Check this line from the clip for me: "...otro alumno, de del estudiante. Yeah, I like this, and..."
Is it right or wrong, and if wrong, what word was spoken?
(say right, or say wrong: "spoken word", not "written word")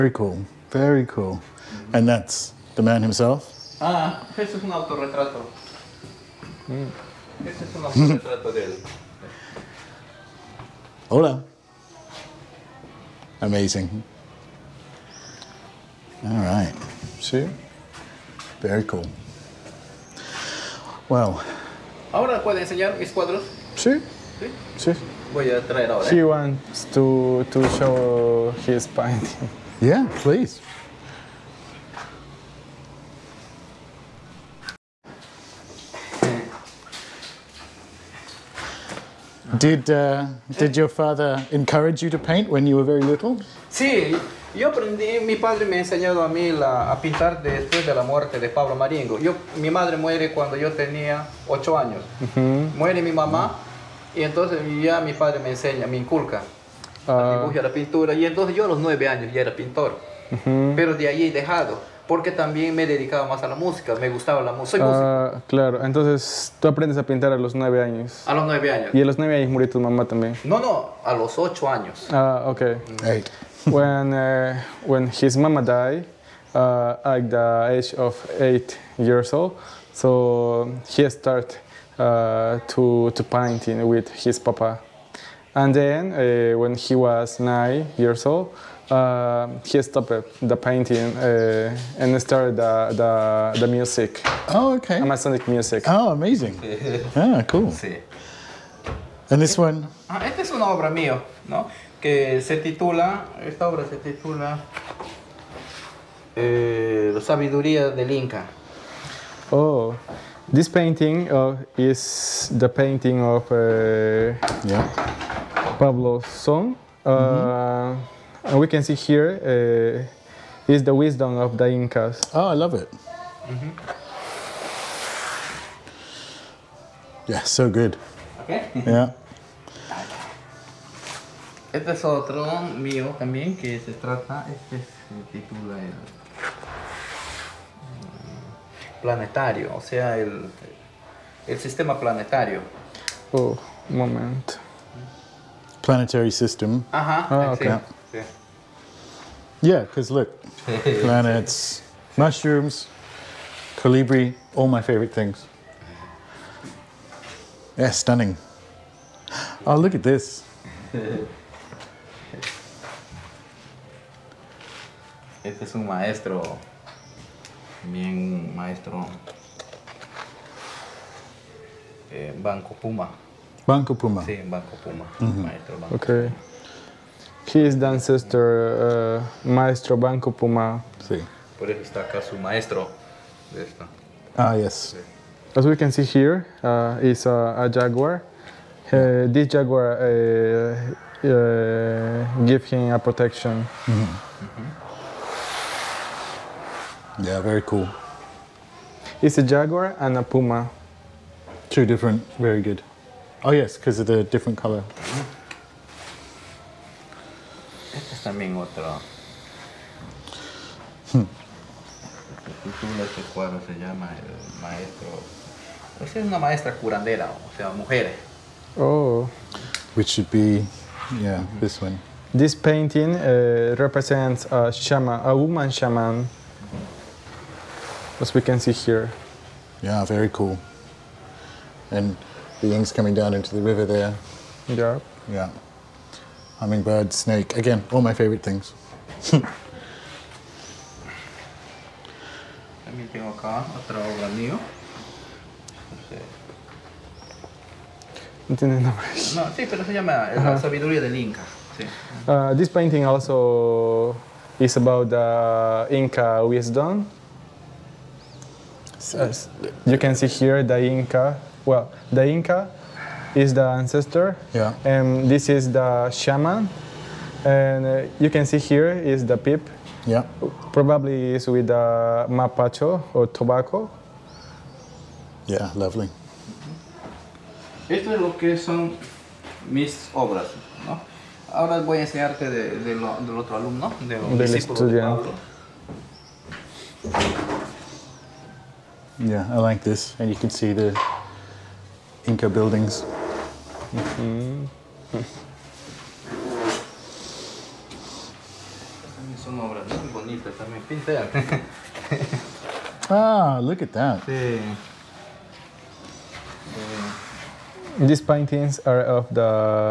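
right.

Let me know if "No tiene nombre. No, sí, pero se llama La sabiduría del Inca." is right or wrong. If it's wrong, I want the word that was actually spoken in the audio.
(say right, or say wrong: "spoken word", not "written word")
right.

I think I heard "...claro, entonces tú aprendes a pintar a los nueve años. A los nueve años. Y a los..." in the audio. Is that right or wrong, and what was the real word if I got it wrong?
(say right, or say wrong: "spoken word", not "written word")
right.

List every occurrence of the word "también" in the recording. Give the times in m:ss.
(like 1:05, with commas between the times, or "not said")
1:02, 1:10, 2:13, 4:02.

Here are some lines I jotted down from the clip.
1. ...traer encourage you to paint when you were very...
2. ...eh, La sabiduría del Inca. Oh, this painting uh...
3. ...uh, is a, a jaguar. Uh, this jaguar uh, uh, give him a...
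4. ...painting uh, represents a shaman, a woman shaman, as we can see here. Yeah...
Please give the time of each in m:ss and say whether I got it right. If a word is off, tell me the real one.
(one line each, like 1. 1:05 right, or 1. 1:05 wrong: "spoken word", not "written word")
1. 0:40 wrong: "father", not "traer"
2. 1:46 right
3. 3:06 right
4. 3:42 right.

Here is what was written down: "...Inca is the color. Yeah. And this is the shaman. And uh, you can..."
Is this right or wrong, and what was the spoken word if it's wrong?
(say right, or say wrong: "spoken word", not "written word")
wrong: "ancestor", not "color".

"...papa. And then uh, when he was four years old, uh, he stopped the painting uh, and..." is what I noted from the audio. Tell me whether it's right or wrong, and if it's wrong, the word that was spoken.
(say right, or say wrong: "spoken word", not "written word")
wrong: "nine", not "four".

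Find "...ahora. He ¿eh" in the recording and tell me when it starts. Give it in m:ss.
0:25.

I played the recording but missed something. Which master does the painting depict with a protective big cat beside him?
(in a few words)
Maestro Banco Puma.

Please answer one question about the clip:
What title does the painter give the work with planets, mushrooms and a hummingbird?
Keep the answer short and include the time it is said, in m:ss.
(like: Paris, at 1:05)
El sistema planetario, at 2:21.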